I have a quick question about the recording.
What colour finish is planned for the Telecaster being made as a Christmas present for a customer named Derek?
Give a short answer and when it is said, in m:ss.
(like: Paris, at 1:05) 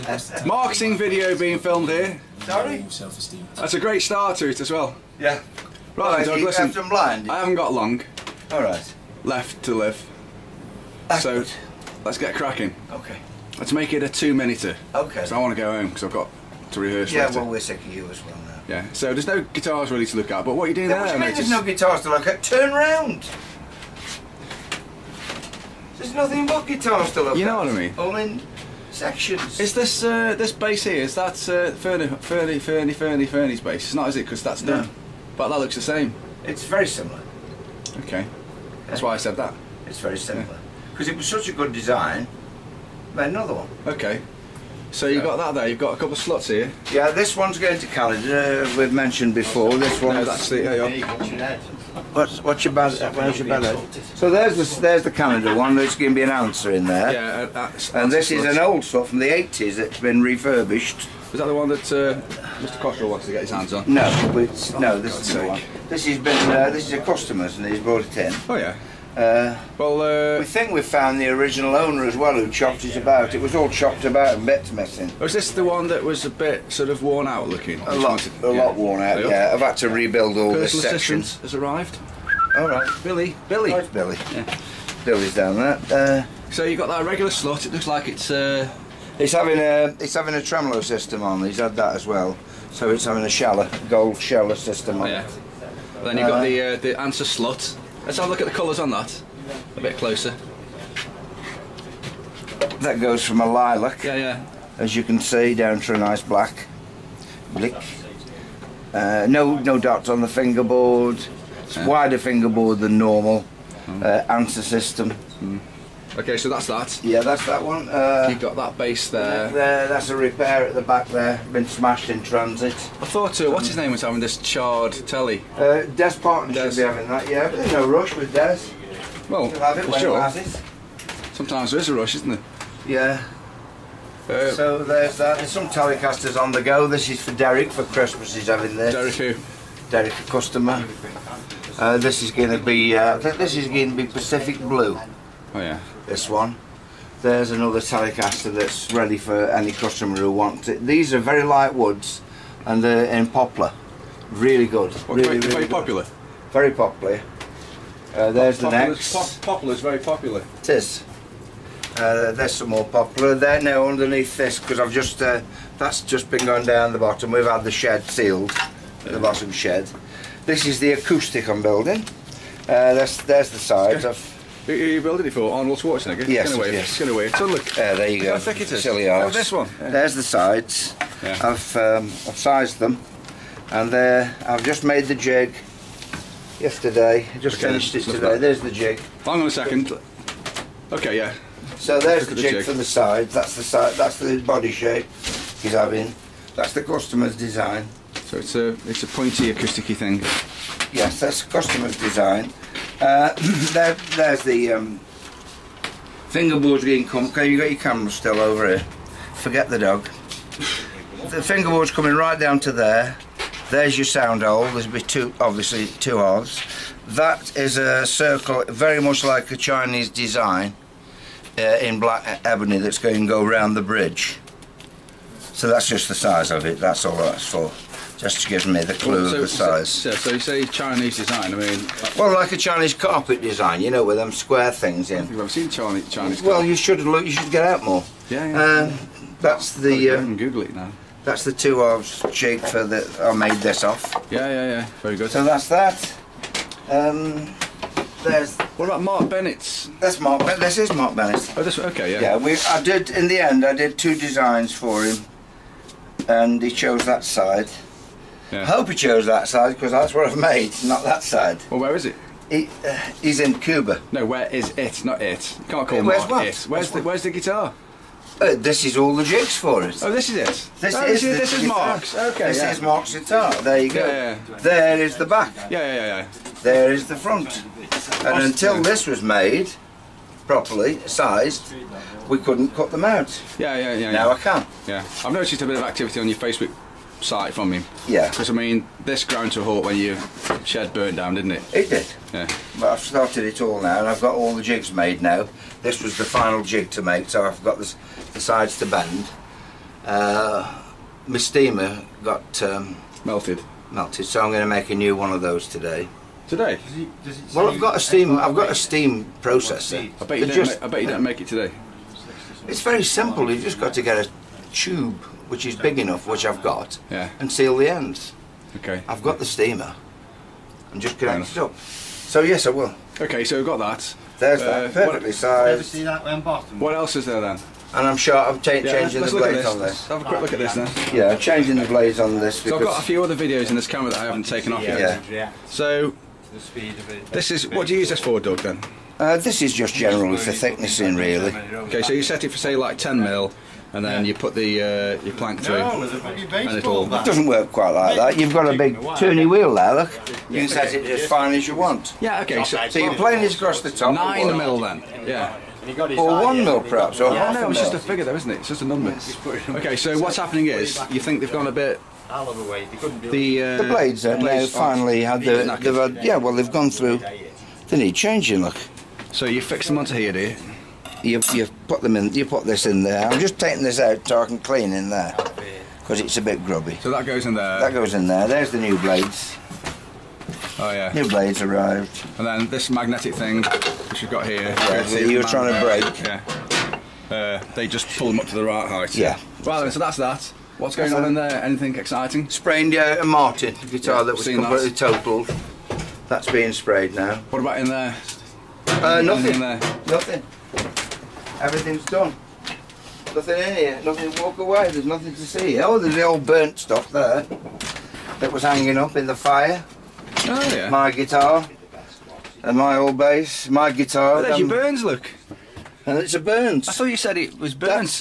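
Pacific Blue, at 2:24.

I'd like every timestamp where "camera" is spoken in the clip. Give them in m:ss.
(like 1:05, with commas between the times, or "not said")
3:27, 5:33.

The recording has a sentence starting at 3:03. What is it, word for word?
And there, I've just made the jig yesterday.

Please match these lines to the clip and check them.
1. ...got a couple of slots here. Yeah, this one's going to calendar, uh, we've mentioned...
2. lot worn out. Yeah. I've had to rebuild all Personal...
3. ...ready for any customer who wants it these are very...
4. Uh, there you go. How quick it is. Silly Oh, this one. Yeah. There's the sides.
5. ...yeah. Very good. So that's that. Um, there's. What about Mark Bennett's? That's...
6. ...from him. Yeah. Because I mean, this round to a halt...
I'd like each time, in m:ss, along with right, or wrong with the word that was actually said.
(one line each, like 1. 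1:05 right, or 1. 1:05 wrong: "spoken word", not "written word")
1. 0:45 right
2. 1:18 right
3. 2:28 right
4. 2:57 wrong: "thick", not "quick"
5. 4:04 right
6. 4:47 wrong: "ground", not "round".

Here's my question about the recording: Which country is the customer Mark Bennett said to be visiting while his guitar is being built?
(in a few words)
Cuba.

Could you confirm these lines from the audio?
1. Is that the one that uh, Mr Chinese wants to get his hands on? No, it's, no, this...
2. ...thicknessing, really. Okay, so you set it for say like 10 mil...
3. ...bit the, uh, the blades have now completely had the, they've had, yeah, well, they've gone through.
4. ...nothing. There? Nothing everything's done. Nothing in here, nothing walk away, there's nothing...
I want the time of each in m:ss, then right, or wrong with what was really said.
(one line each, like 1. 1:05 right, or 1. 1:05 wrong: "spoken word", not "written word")
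1. 1:01 wrong: "Cottrell", not "Chinese"
2. 5:40 right
3. 6:01 wrong: "finally", not "completely"
4. 6:39 right.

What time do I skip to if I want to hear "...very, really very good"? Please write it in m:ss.
2:35.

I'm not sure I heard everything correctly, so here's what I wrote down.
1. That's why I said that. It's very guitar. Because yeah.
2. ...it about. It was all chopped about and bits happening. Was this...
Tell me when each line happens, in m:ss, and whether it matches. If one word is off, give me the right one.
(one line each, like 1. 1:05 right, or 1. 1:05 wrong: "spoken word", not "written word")
1. 0:38 wrong: "similar", not "guitar"
2. 1:12 wrong: "missing", not "happening".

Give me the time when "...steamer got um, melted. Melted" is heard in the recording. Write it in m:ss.
5:01.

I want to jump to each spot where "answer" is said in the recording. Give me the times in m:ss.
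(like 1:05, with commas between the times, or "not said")
0:56, 1:37, 1:54.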